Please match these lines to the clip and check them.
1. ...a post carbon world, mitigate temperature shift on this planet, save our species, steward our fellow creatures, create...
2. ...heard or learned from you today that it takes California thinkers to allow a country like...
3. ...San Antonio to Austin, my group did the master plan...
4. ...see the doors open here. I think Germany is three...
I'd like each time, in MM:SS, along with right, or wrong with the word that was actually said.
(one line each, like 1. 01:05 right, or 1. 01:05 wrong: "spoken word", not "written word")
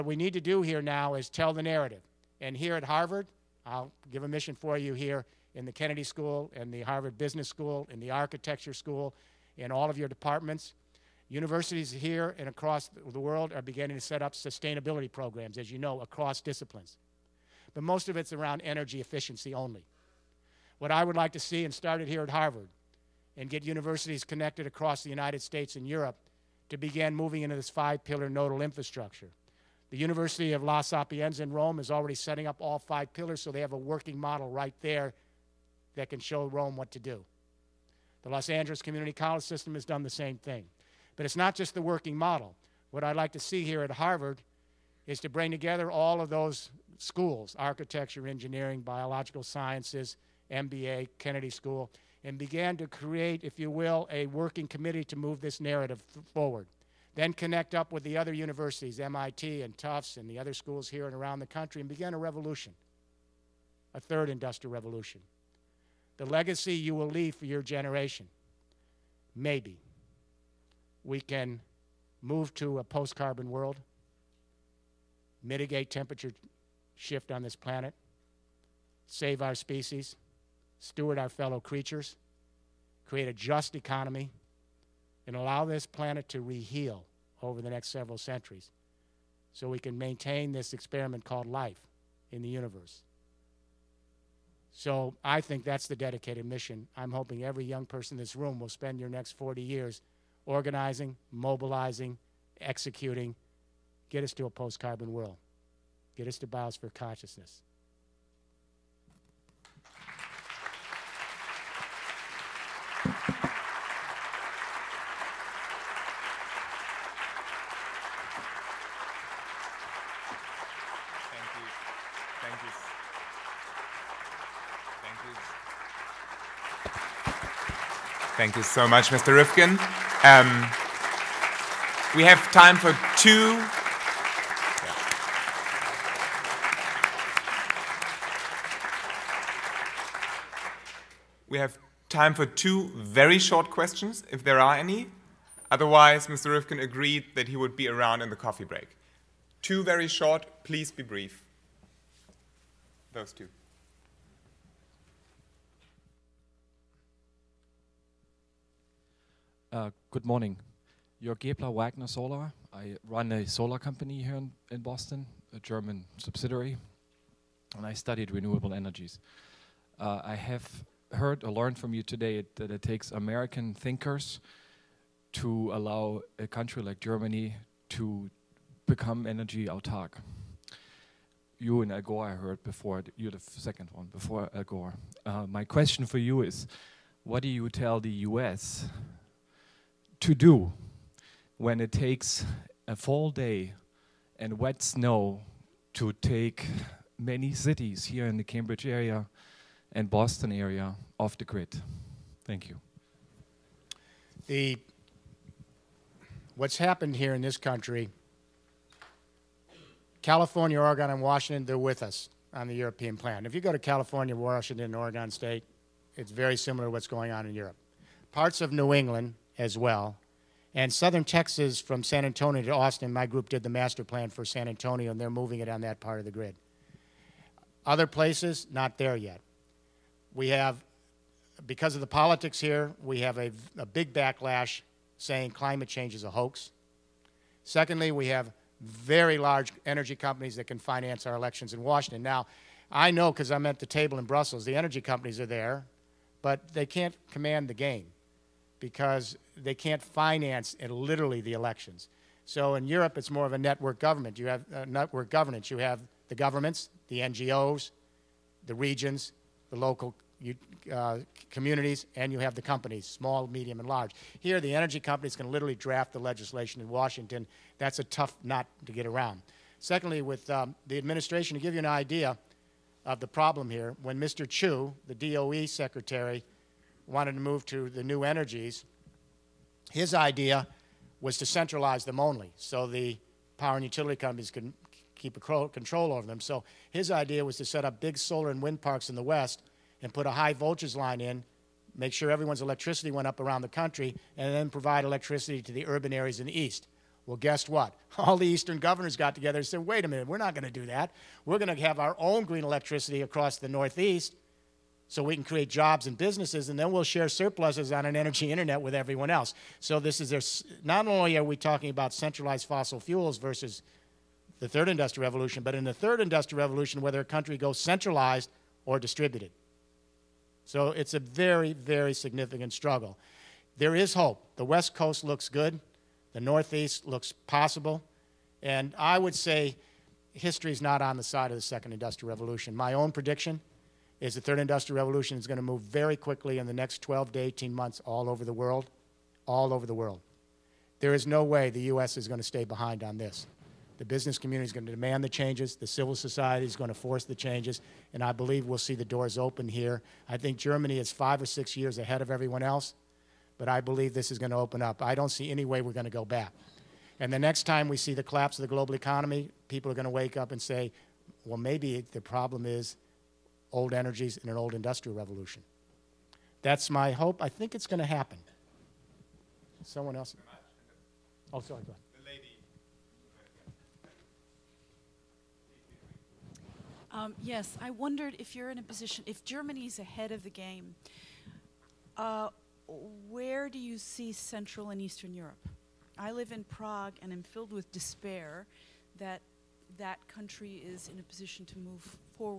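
1. 01:12 right
2. 02:51 wrong: "American", not "California"
3. 03:42 right
4. 05:48 wrong: "five", not "three".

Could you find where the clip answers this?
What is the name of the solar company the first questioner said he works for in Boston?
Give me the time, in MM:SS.
02:41.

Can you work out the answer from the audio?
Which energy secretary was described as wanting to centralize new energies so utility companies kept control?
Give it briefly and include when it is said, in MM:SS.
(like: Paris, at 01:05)
Mr. Chu, at 04:34.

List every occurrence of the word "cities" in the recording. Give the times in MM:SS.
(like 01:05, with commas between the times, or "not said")
03:17.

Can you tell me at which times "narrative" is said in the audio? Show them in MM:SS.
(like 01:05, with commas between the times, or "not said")
00:01, 00:55.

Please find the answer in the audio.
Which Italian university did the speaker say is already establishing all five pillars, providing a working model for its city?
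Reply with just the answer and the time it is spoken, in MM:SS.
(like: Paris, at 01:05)
La Sapienza, at 00:30.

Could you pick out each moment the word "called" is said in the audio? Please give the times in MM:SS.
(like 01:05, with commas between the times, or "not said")
01:31.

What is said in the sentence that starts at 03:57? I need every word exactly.
Secondly, we have very large energy companies that can finance our elections in Washington.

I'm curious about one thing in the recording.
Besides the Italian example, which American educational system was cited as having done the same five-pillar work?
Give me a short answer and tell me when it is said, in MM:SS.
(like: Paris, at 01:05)
Los Angeles Community College, at 00:38.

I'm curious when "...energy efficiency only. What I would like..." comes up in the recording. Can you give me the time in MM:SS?
00:18.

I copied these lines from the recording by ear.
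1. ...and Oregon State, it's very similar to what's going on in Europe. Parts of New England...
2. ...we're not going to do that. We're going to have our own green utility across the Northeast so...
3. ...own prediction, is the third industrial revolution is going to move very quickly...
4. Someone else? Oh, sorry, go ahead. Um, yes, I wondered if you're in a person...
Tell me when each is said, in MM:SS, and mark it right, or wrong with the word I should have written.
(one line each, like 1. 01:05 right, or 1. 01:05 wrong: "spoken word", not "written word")
1. 03:34 right
2. 05:00 wrong: "electricity", not "utility"
3. 05:32 right
4. 06:09 wrong: "position", not "person".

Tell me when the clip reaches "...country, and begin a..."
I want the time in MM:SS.
01:01.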